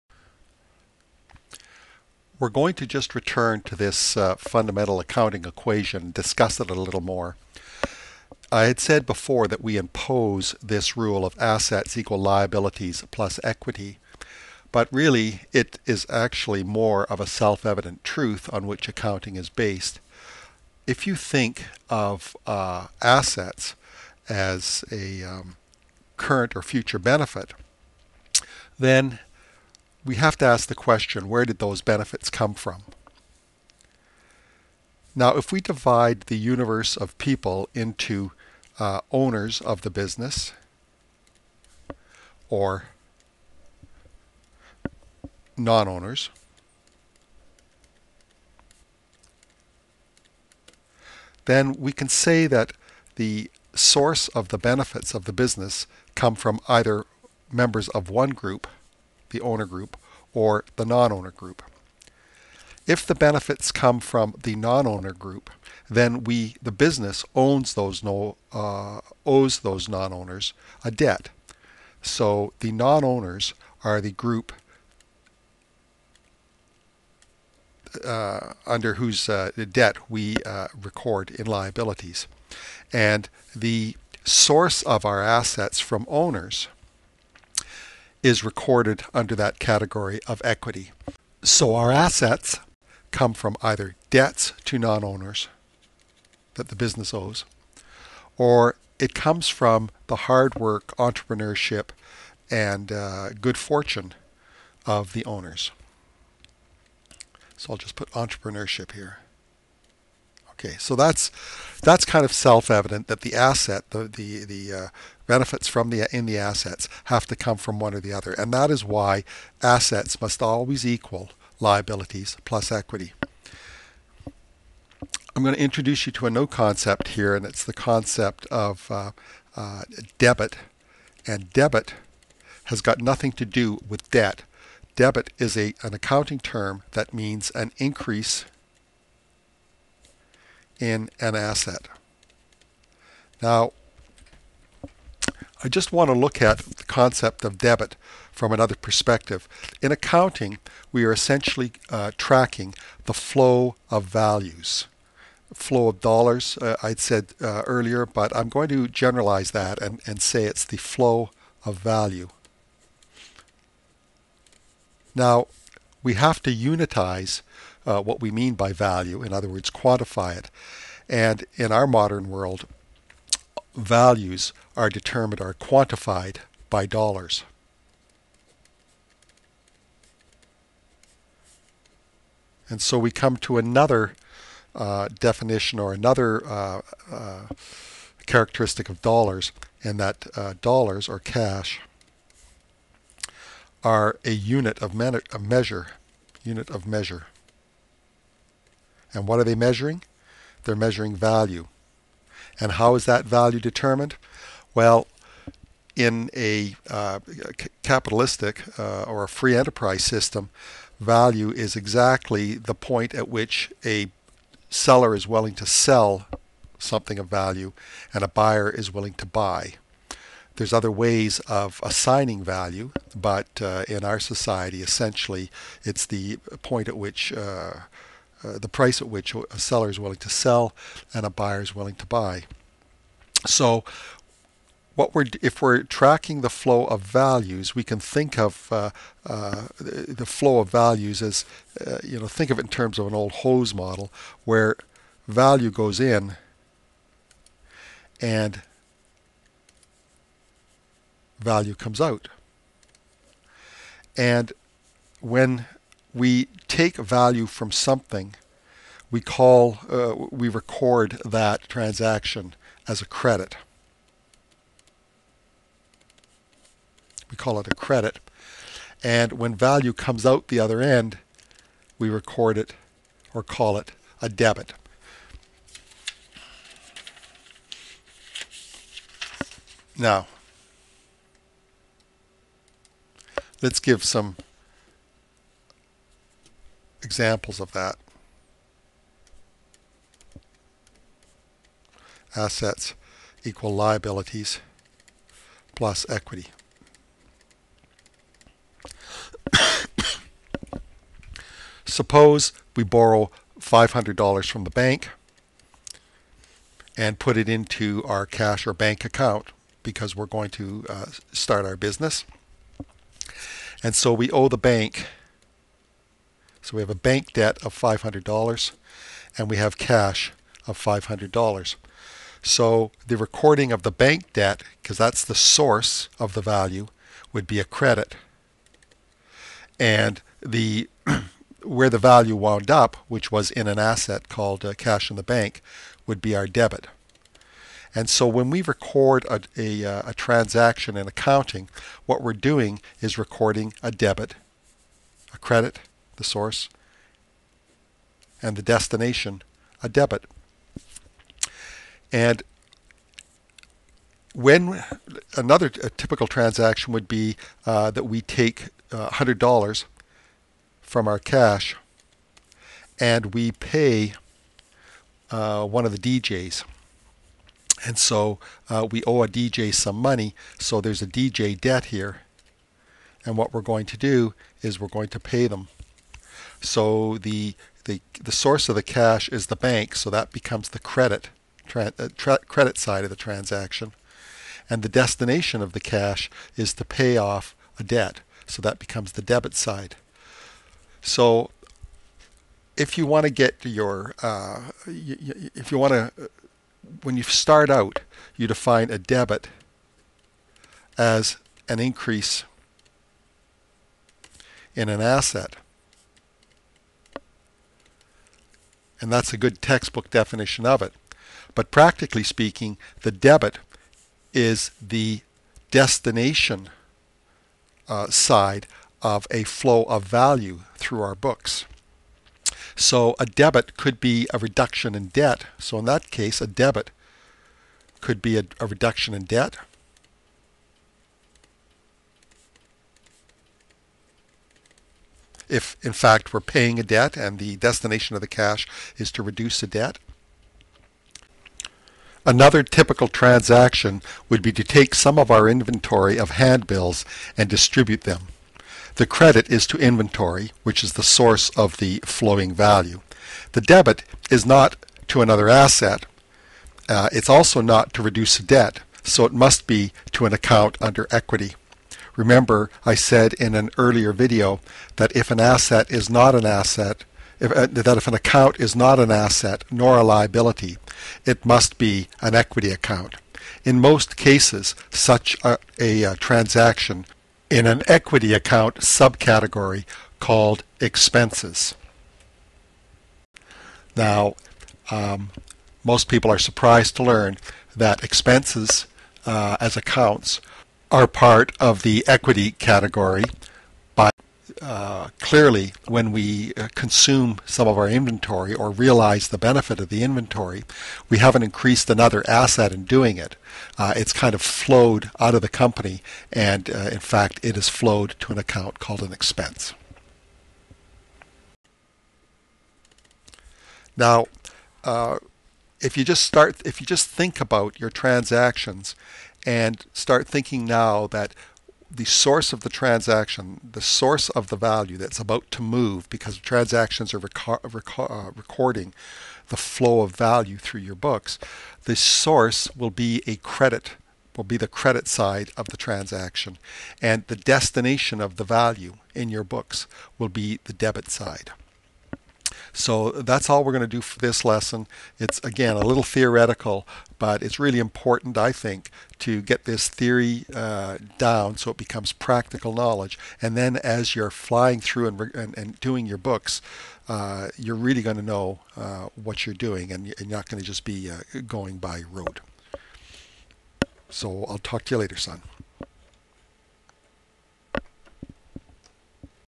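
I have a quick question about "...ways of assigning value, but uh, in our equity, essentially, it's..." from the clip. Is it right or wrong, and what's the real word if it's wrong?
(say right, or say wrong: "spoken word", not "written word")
wrong: "society", not "equity".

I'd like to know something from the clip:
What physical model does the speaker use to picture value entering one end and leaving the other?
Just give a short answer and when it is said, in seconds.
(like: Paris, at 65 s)
hose model, at 243 s.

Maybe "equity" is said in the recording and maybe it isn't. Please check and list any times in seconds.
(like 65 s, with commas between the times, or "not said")
13 s, 90 s, 122 s, 296 s, 461 s, 472 s, 477 s, 492 s.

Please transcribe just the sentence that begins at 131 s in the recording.
And debit has got nothing to do with debt.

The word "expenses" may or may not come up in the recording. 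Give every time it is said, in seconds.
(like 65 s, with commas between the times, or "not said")
480 s, 488 s, 509 s.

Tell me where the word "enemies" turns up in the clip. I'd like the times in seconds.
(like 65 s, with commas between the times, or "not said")
not said.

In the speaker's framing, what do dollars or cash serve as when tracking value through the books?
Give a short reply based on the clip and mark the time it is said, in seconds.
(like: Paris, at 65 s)
unit of measure, at 196 s.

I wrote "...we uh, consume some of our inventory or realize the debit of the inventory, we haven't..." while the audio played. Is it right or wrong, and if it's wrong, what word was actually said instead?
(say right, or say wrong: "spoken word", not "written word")
wrong: "benefit", not "debit".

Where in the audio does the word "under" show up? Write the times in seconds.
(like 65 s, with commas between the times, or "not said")
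78 s, 89 s, 460 s.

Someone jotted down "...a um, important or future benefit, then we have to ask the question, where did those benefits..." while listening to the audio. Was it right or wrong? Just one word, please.
wrong.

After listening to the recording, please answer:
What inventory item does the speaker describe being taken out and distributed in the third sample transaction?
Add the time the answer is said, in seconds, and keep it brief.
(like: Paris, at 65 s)
handbills, at 446 s.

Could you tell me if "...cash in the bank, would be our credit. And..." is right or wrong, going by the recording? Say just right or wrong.
wrong.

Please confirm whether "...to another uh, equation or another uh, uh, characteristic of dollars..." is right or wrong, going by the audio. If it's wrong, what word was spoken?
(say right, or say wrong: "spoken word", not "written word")
wrong: "definition", not "equation".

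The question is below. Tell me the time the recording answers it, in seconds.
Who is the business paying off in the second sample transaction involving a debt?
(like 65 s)
366 s.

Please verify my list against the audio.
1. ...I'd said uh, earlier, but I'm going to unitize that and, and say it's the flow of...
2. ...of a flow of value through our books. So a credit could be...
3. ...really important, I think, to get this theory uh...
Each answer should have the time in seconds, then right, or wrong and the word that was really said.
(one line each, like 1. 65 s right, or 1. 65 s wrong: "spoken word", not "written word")
1. 156 s wrong: "generalize", not "unitize"
2. 419 s wrong: "debit", not "credit"
3. 547 s right.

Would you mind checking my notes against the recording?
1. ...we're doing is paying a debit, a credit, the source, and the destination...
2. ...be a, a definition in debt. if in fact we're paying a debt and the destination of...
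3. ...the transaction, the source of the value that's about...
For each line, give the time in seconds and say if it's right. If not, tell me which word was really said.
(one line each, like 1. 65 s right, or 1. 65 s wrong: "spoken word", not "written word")
1. 342 s wrong: "recording", not "paying"
2. 428 s wrong: "reduction", not "definition"
3. 522 s right.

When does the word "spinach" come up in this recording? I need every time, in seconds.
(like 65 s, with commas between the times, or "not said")
not said.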